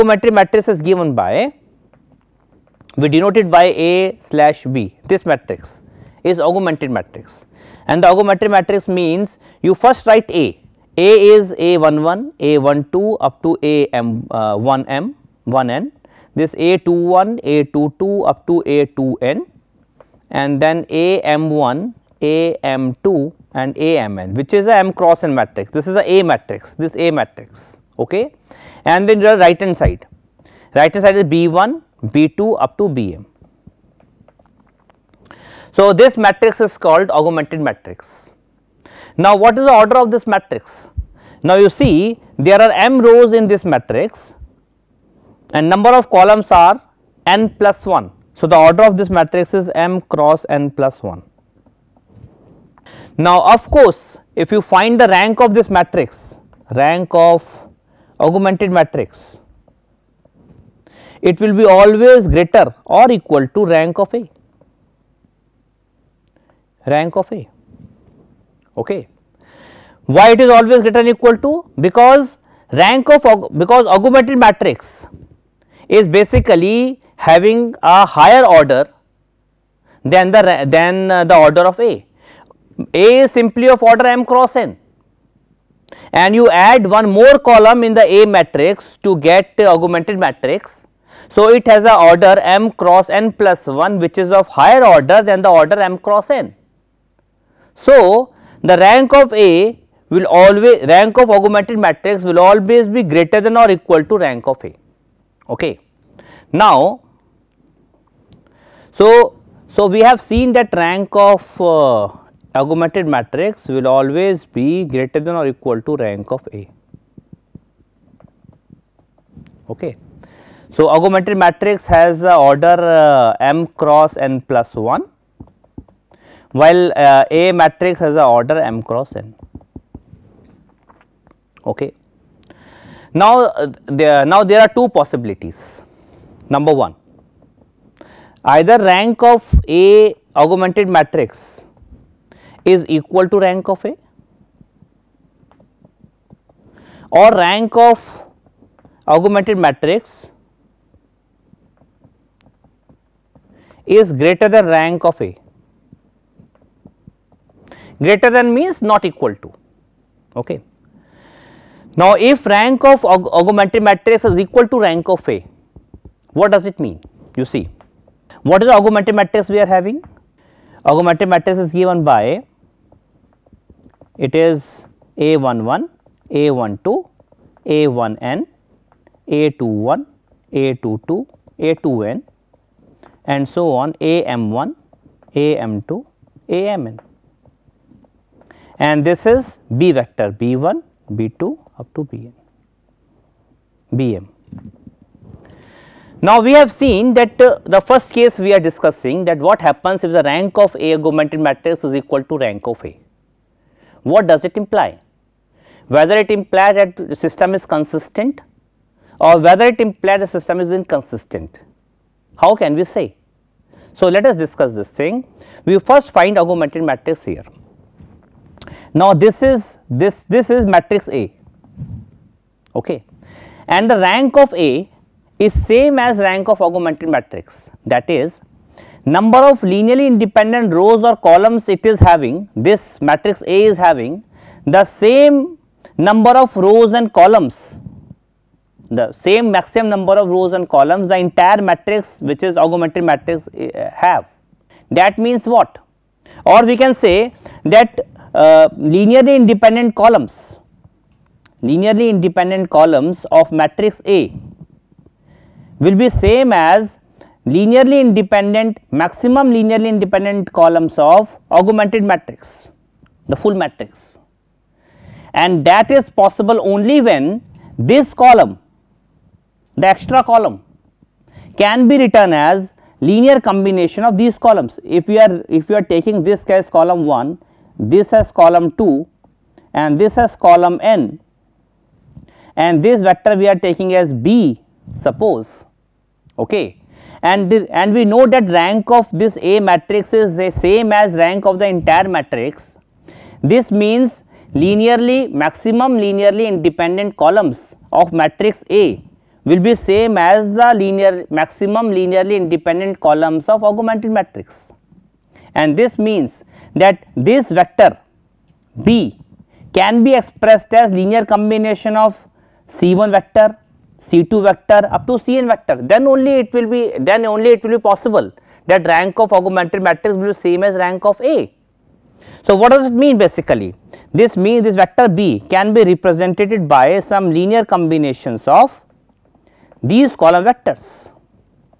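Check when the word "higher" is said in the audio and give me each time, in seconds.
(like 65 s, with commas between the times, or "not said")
78 s, 94 s.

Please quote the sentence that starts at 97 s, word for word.
So, the rank of A will always rank of augmented matrix will always be greater than or equal to rank of A.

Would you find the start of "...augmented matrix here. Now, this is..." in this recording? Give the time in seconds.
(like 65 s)
216 s.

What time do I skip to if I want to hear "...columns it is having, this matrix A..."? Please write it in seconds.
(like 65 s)
231 s.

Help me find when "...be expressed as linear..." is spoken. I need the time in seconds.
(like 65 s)
310 s.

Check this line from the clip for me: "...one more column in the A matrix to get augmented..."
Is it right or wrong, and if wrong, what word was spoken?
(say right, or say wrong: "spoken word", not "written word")
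right.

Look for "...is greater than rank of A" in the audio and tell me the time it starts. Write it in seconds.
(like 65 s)
153 s.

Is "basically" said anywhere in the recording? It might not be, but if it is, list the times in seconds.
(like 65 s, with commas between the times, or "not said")
76 s, 323 s.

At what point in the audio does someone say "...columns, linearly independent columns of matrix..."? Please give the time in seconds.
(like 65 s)
249 s.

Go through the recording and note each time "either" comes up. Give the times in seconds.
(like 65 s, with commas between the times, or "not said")
138 s.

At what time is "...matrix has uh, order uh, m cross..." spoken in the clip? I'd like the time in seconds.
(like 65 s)
121 s.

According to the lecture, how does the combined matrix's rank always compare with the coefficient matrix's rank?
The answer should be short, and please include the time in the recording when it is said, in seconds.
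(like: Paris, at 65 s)
greater or equal, at 62 s.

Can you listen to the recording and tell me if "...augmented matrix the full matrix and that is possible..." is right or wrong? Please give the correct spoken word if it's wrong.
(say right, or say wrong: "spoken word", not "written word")
right.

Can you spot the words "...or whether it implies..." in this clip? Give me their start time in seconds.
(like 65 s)
209 s.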